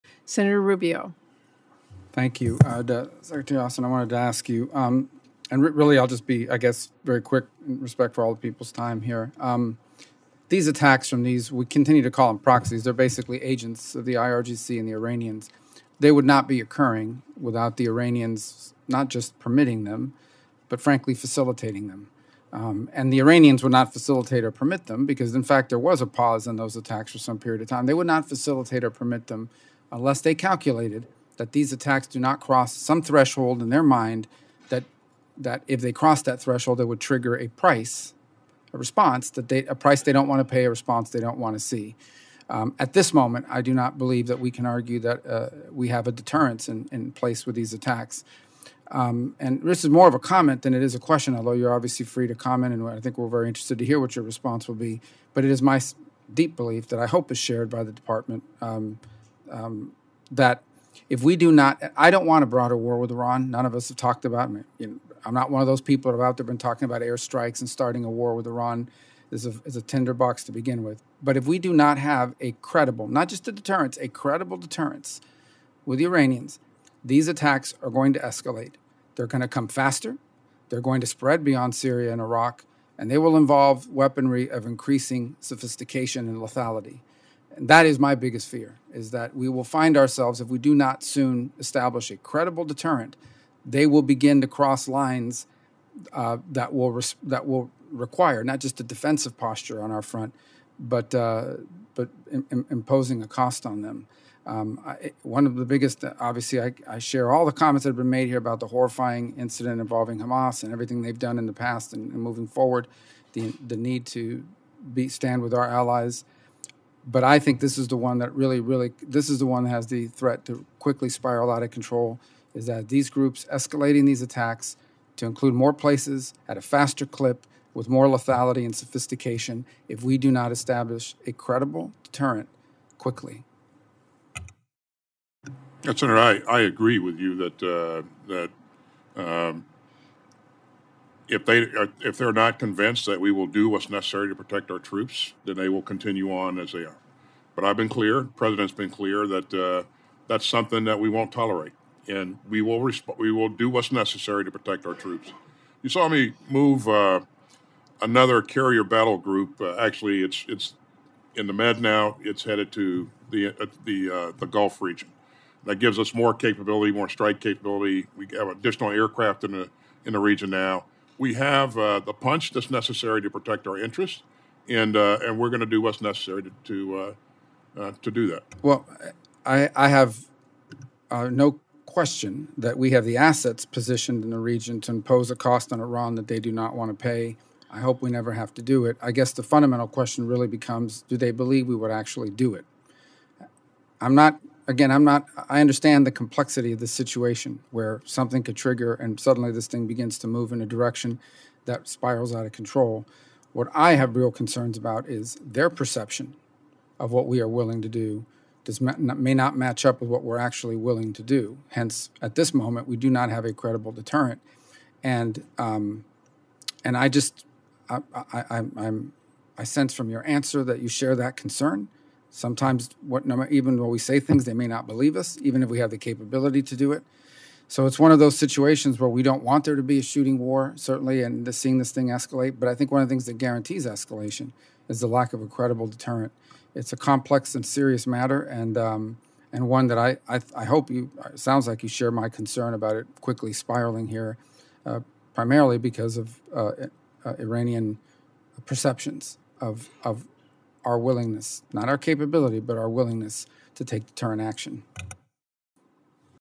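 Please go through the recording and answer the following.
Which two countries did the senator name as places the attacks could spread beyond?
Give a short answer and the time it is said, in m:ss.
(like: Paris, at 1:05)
Syria and Iraq, at 1:21.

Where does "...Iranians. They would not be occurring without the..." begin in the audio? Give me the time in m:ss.
0:14.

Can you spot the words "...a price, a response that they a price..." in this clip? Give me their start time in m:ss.
0:37.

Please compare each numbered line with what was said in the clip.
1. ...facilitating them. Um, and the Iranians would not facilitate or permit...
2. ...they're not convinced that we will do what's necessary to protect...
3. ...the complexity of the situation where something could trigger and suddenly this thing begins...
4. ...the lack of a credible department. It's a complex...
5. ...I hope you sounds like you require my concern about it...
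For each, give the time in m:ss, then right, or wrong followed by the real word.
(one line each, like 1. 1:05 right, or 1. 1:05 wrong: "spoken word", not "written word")
1. 0:21 right
2. 2:22 right
3. 3:16 right
4. 3:55 wrong: "deterrent", not "department"
5. 4:00 wrong: "share", not "require".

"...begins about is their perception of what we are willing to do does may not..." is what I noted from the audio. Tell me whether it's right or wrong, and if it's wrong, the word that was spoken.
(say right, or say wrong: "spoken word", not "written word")
wrong: "concerns", not "begins".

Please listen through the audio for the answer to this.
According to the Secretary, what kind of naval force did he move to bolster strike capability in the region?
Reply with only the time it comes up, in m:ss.
2:38.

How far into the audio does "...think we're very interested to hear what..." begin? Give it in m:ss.
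0:52.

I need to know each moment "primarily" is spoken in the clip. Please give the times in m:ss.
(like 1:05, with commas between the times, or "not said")
4:05.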